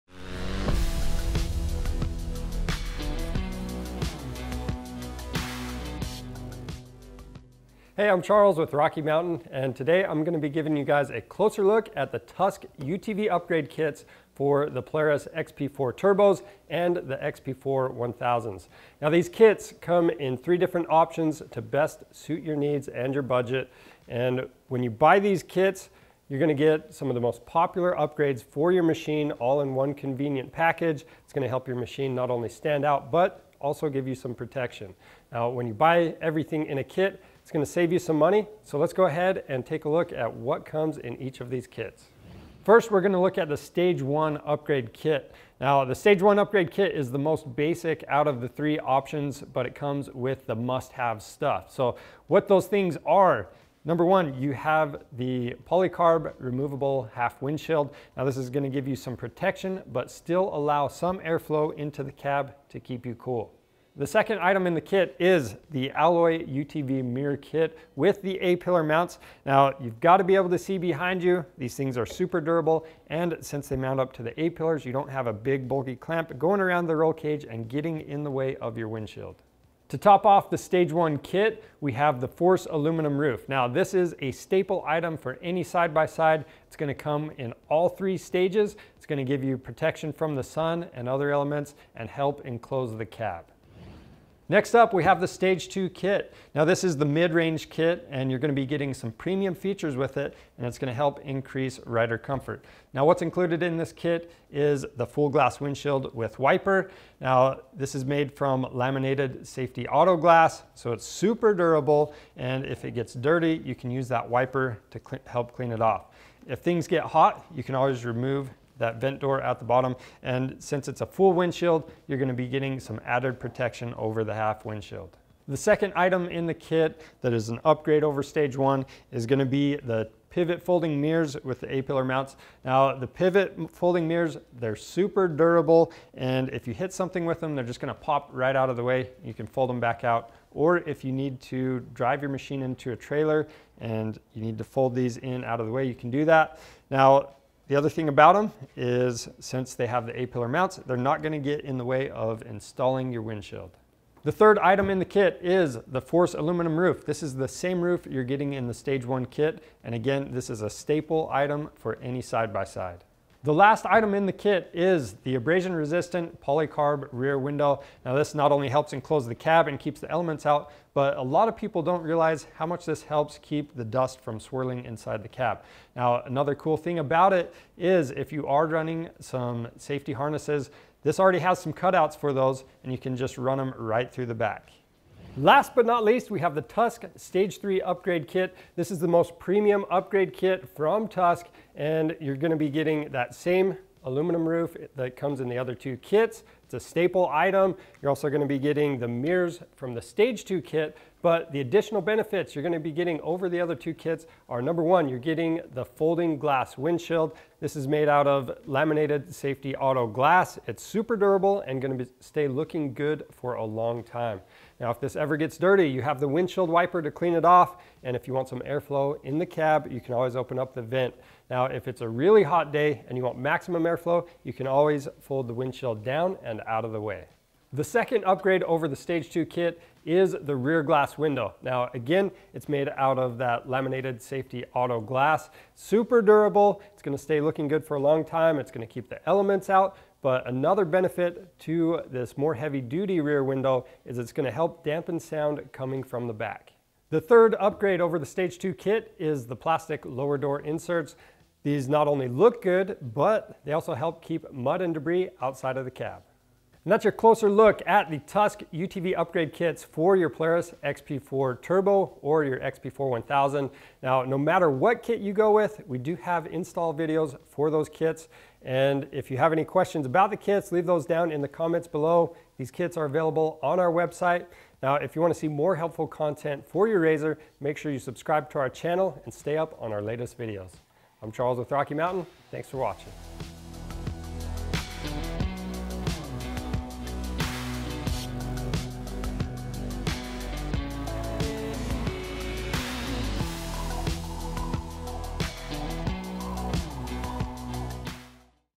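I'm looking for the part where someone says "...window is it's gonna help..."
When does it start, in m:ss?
4:03.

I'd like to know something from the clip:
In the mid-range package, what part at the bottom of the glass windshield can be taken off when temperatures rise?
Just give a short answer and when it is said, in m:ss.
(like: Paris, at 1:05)
Vent door, at 1:58.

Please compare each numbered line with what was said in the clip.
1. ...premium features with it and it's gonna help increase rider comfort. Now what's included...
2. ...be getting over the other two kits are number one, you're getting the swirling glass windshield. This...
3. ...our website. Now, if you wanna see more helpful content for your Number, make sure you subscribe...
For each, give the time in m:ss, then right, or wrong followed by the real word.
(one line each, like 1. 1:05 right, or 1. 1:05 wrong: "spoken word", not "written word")
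1. 1:39 right
2. 3:22 wrong: "folding", not "swirling"
3. 4:33 wrong: "RZR", not "Number".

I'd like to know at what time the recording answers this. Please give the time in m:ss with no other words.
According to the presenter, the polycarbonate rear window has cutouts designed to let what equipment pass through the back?
2:59.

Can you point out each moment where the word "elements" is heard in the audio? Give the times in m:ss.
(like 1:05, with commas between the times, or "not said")
1:31, 2:50, 3:59.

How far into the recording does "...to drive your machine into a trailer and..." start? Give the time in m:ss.
2:21.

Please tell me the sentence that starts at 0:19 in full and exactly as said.
Now these kits come in three different options to best suit your needs and your budget.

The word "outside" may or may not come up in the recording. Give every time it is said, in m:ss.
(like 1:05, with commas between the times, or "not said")
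4:15.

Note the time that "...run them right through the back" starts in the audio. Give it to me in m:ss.
3:03.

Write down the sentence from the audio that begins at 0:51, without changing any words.
So what those things are, Number one, you have the polycarb removable half windshield.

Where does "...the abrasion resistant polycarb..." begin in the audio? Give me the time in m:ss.
2:45.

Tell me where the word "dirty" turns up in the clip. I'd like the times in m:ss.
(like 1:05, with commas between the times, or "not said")
1:53, 3:35.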